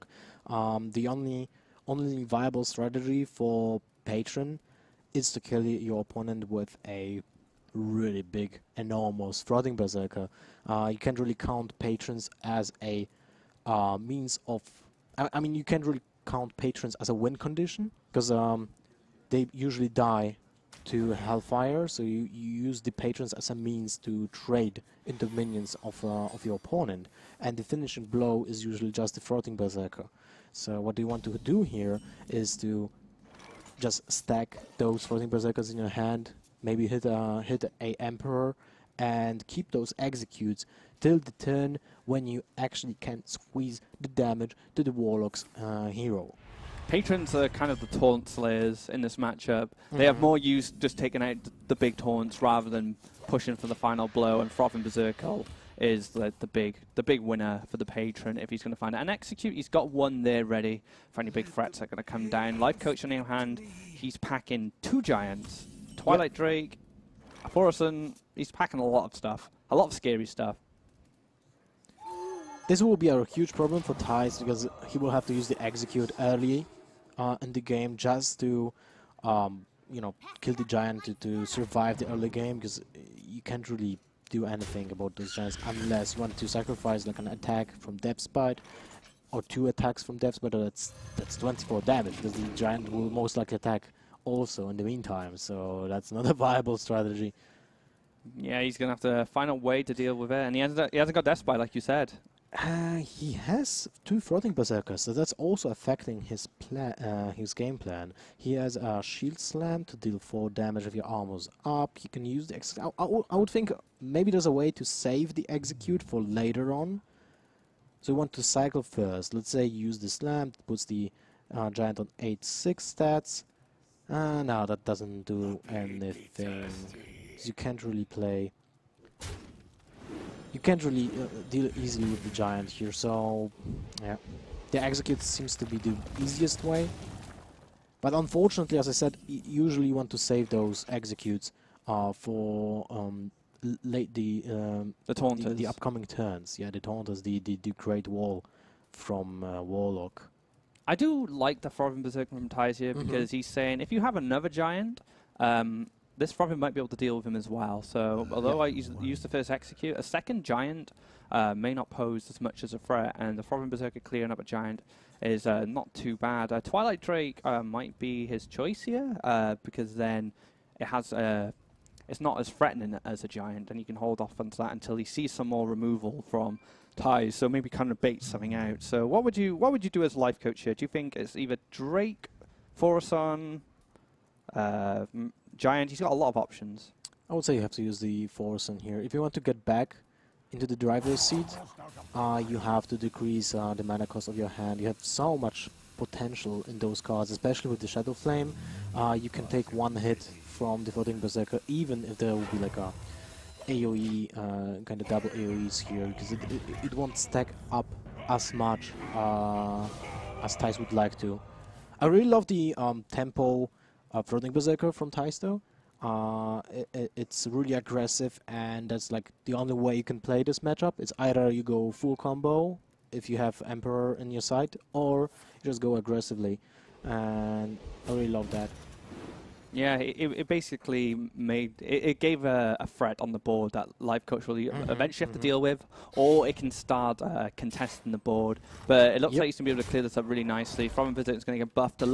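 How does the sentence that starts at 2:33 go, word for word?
because he's saying if you have another giant, um, this Frothing might be able to deal with him as well.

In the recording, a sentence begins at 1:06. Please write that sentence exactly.
Drake, Aphorison, he's packing a lot of stuff, a lot of scary stuff.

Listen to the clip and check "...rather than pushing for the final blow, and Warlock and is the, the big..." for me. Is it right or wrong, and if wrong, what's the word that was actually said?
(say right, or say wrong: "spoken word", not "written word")
wrong: "Froth", not "Warlock".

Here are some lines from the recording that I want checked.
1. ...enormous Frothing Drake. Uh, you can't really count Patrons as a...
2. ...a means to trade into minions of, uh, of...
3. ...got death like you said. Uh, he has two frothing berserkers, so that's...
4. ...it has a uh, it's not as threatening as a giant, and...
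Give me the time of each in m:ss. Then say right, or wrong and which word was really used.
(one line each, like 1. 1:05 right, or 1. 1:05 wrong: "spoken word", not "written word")
1. 0:08 wrong: "Berserker", not "Drake"
2. 0:23 right
3. 1:41 right
4. 2:50 right.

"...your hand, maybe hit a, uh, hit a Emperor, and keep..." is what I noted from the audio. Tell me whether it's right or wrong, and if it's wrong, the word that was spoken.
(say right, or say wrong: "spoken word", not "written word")
right.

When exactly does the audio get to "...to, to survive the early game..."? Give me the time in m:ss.
1:21.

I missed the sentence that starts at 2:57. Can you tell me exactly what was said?
So maybe kind of bait something hmm.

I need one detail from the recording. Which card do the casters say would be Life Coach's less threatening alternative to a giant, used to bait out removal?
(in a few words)
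Twilight Drake.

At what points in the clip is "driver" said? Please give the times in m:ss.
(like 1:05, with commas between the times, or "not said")
3:10.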